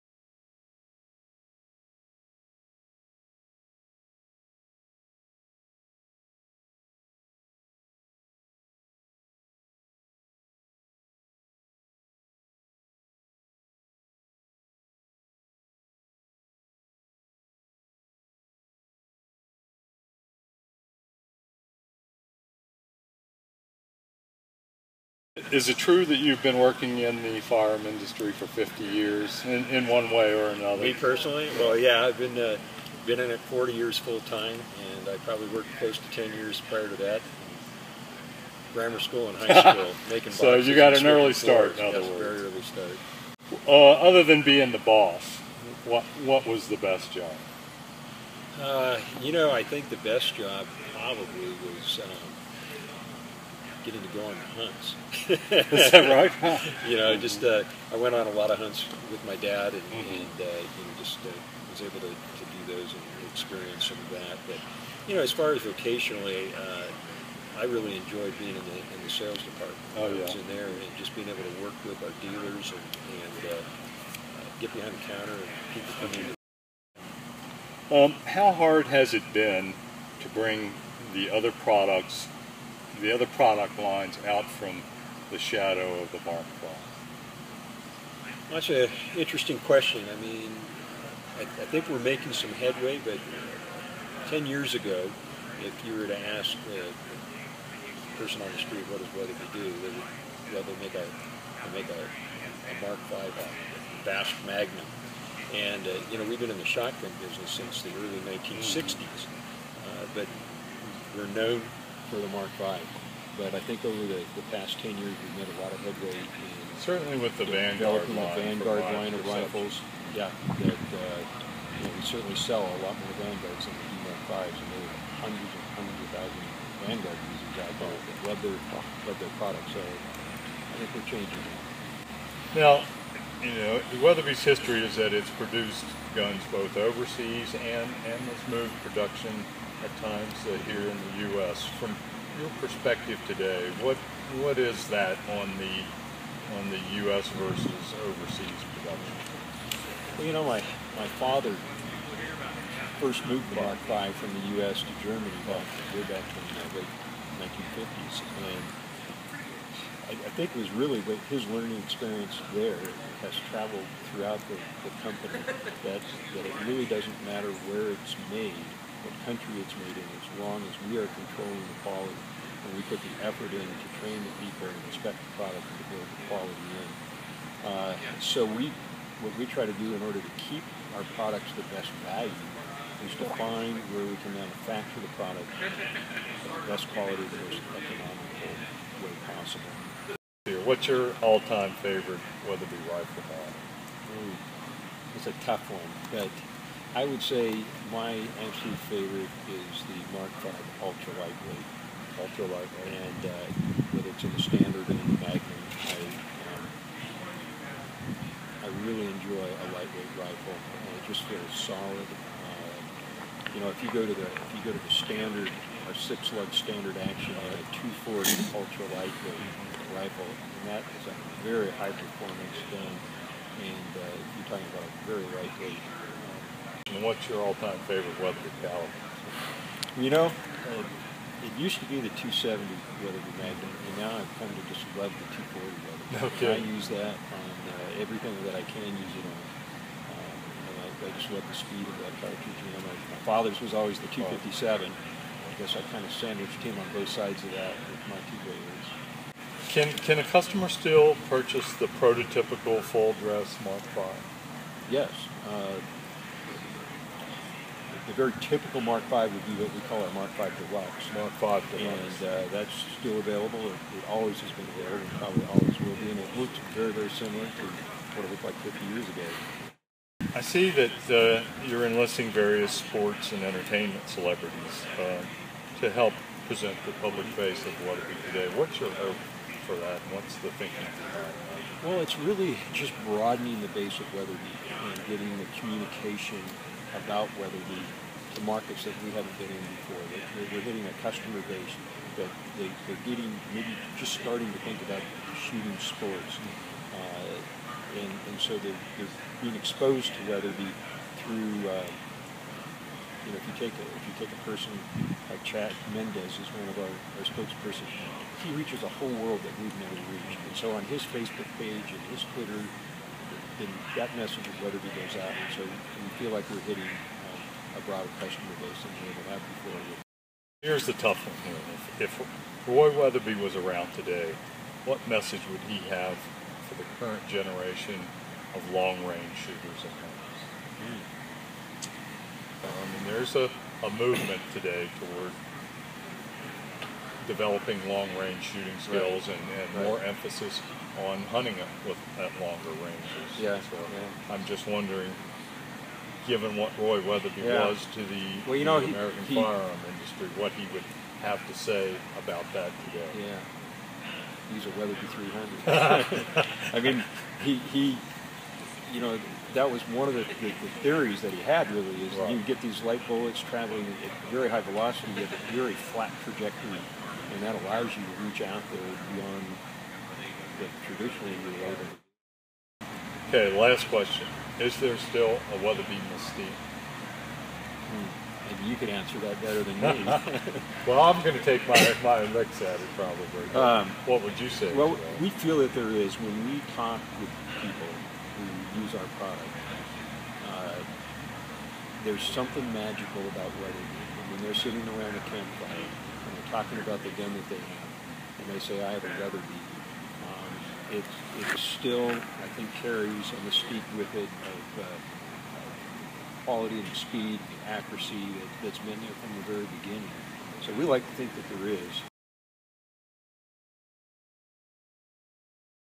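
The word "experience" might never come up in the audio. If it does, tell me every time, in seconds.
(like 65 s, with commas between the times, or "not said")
63 s, 161 s.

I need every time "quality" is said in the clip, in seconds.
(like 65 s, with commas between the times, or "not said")
171 s, 176 s, 186 s, 406 s.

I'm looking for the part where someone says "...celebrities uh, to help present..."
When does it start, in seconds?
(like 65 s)
274 s.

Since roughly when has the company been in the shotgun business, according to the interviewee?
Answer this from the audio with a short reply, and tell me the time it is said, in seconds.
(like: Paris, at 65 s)
early 1960s, at 107 s.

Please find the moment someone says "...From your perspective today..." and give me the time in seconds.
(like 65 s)
141 s.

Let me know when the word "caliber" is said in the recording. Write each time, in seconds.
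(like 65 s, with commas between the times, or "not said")
228 s.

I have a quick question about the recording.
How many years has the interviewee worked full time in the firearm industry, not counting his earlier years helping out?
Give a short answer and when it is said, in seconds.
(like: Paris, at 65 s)
40, at 33 s.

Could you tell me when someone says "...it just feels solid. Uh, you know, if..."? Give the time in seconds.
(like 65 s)
210 s.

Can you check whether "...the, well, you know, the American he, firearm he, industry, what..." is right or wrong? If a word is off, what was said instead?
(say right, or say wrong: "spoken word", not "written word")
right.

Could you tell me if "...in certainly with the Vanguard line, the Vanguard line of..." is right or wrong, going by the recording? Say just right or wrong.
right.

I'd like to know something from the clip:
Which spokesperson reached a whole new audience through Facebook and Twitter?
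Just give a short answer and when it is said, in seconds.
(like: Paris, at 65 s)
Chad Mendes, at 305 s.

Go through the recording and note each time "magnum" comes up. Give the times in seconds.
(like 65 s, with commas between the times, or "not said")
104 s, 205 s, 233 s.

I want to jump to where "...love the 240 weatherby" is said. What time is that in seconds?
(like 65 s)
234 s.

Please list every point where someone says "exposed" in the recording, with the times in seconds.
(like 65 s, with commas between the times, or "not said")
299 s.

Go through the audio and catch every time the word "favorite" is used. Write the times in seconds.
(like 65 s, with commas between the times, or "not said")
191 s, 198 s, 227 s.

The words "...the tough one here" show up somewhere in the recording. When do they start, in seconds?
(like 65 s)
320 s.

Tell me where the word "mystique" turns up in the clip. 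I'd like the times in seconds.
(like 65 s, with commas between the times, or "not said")
376 s, 403 s.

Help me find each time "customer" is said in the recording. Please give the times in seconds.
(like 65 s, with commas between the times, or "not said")
250 s, 291 s, 318 s.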